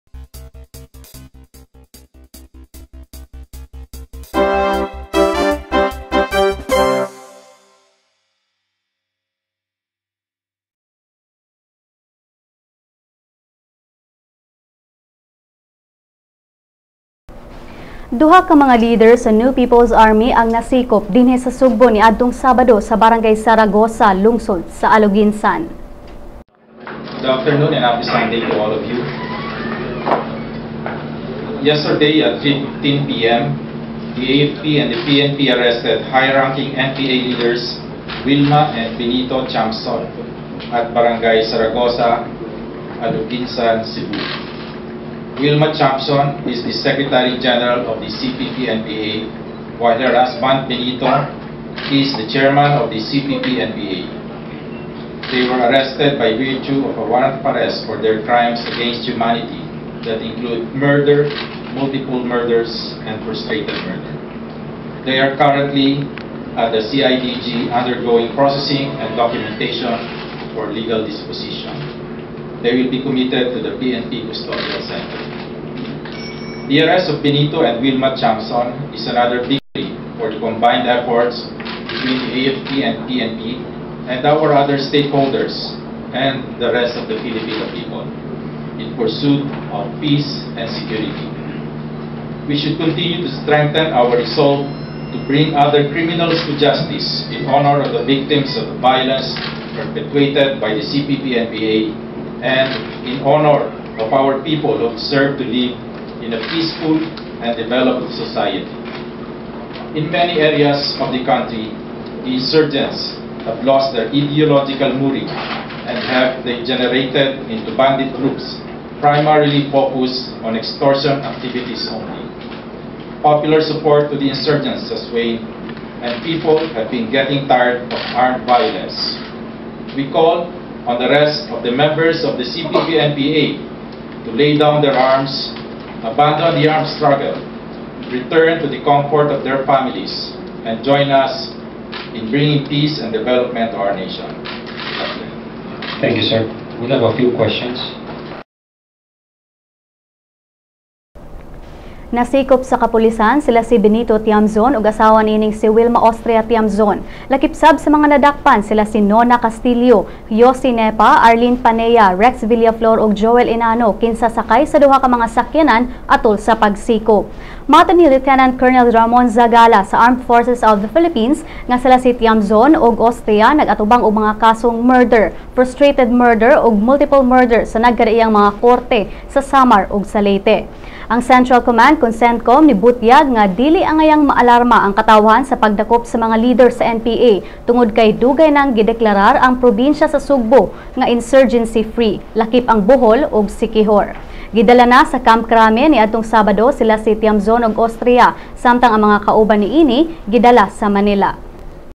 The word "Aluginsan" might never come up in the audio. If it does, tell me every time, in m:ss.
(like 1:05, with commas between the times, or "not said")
0:24, 0:43.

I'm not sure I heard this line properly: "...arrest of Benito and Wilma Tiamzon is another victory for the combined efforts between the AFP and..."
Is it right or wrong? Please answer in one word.
right.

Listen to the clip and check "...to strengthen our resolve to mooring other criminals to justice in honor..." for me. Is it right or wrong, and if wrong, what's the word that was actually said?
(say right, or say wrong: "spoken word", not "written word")
wrong: "bring", not "mooring".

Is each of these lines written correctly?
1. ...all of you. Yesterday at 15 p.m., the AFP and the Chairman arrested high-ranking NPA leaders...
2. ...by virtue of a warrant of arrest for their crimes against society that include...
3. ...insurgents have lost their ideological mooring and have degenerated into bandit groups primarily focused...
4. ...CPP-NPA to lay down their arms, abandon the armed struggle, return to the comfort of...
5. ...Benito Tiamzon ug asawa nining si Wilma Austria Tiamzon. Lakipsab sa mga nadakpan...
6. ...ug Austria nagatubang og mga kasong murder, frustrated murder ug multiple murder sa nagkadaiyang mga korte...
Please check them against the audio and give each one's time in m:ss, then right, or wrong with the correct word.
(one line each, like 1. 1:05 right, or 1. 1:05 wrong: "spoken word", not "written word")
1. 0:28 wrong: "PNP", not "Chairman"
2. 0:56 wrong: "humanity", not "society"
3. 1:52 right
4. 2:12 right
5. 2:33 right
6. 2:52 right.